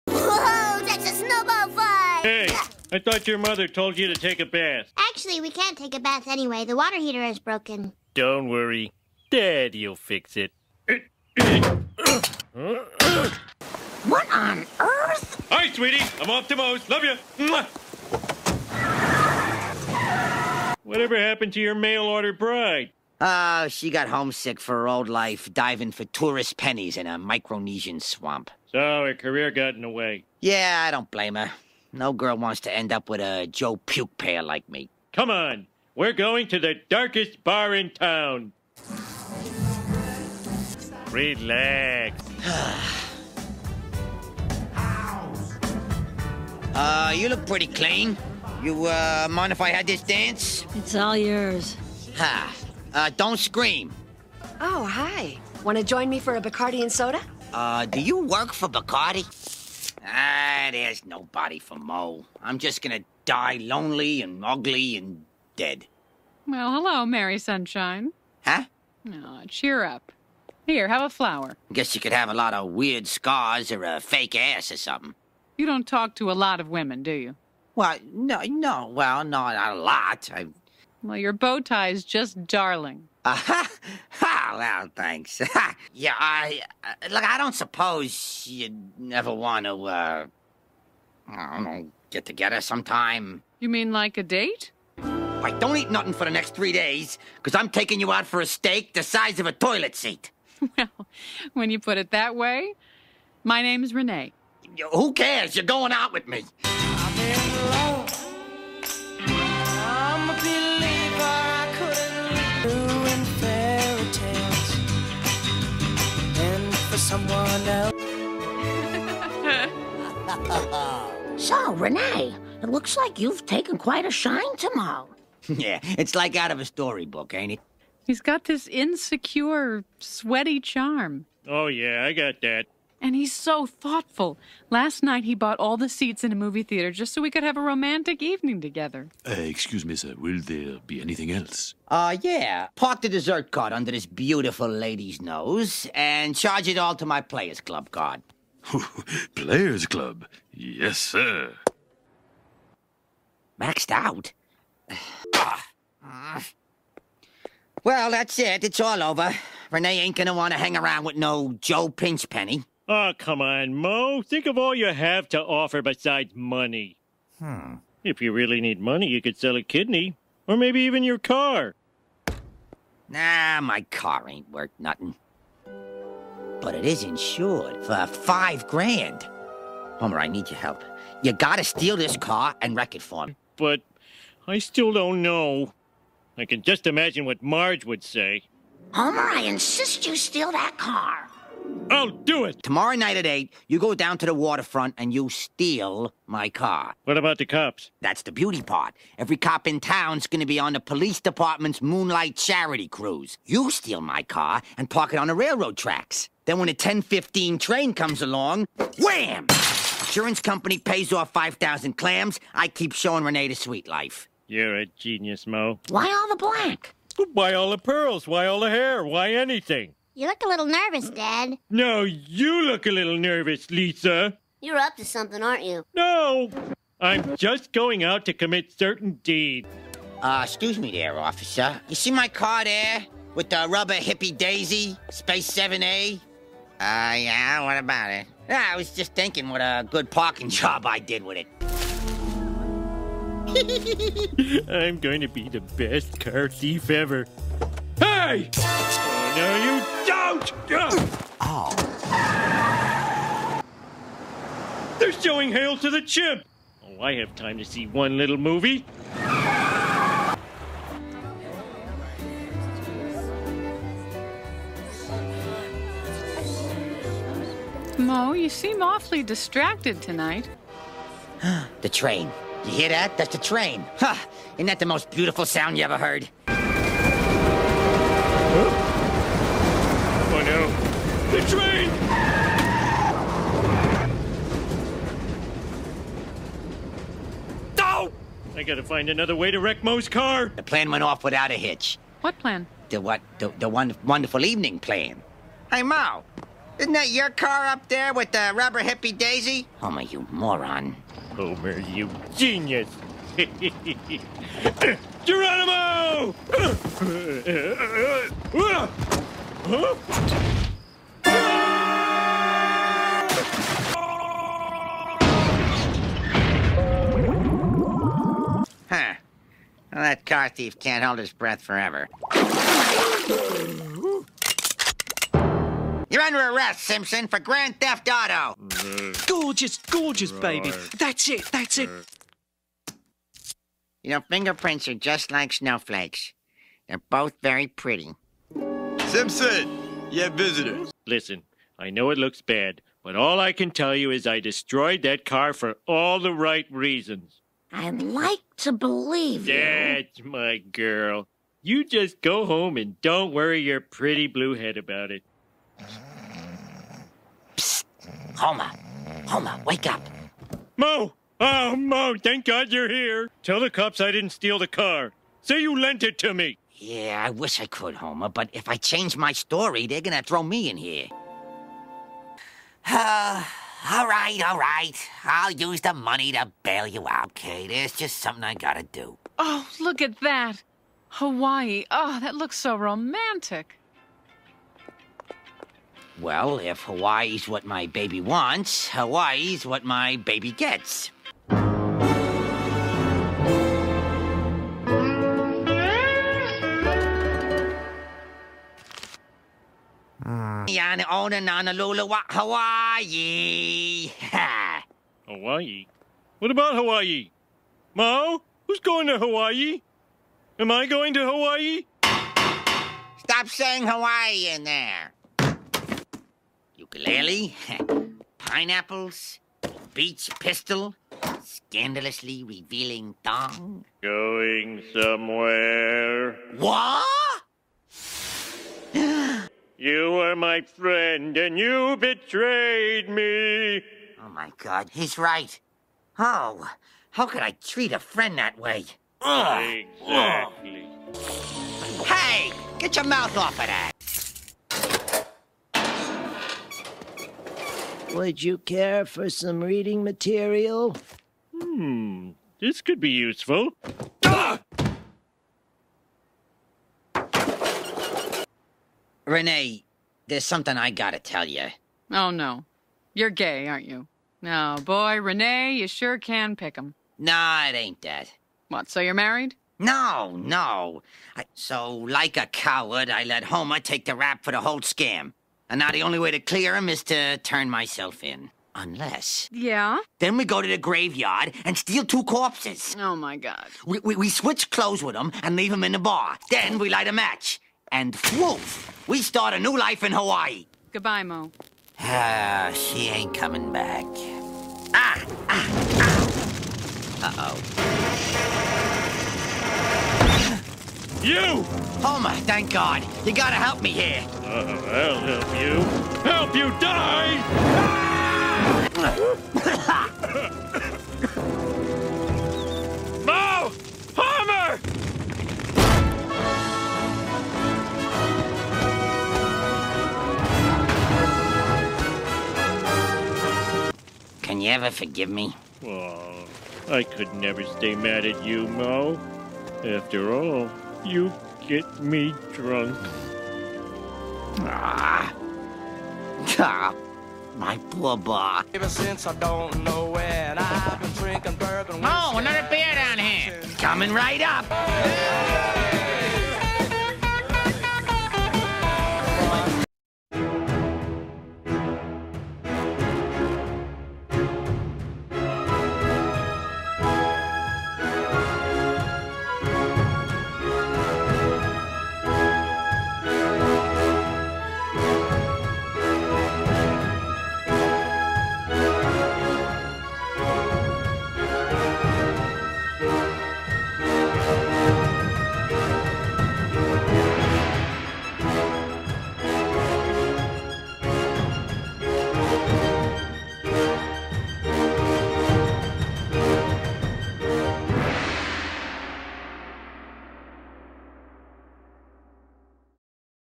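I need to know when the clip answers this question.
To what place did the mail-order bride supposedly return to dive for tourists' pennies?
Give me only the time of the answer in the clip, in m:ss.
0:27.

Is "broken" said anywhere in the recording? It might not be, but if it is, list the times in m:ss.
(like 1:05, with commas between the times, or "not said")
0:07.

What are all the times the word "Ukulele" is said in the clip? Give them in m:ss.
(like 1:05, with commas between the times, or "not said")
6:56.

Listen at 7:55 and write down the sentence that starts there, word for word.
And now the only way to clear him is to turn myself in.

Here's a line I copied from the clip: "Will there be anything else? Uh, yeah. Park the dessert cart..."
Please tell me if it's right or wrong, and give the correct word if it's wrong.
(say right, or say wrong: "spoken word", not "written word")
right.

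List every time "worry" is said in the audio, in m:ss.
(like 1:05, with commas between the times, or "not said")
0:08, 5:53.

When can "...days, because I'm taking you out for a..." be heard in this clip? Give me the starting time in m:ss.
1:36.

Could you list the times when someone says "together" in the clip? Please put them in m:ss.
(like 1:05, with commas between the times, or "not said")
1:32, 2:18.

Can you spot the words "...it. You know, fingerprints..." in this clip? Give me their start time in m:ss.
5:31.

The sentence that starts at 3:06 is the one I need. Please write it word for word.
I can just imagine what Marge would say.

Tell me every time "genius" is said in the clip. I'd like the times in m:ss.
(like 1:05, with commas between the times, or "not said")
3:34, 5:02.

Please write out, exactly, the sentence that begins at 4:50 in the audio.
The plan went off without a hitch.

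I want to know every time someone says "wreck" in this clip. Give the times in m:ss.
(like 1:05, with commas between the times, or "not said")
3:02, 4:49.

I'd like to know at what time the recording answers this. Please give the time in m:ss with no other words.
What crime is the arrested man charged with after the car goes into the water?
5:27.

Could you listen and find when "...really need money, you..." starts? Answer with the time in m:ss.
2:48.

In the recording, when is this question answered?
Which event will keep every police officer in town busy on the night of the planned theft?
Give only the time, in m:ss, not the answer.
3:21.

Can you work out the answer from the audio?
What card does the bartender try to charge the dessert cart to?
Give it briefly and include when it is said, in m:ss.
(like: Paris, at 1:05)
Players Club card, at 2:27.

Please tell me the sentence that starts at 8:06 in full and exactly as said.
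Then we light a match and woof, we start a new life in Hawaii.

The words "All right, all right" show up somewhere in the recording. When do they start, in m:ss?
6:13.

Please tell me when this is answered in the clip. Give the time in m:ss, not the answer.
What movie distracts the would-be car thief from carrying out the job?
4:15.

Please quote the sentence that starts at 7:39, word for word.
Renee, there's something I gotta tell you.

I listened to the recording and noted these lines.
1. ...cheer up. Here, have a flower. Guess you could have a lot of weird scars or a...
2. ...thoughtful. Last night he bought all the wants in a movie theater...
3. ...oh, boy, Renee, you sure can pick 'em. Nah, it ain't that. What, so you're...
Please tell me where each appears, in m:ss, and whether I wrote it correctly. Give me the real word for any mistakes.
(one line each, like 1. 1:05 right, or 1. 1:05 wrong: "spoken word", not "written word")
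1. 1:09 right
2. 2:13 wrong: "seats", not "wants"
3. 7:44 right.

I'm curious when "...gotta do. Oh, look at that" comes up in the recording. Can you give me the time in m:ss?
6:18.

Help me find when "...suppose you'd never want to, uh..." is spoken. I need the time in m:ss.
1:27.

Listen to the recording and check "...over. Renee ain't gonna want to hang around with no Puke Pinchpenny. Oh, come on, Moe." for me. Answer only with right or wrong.
wrong.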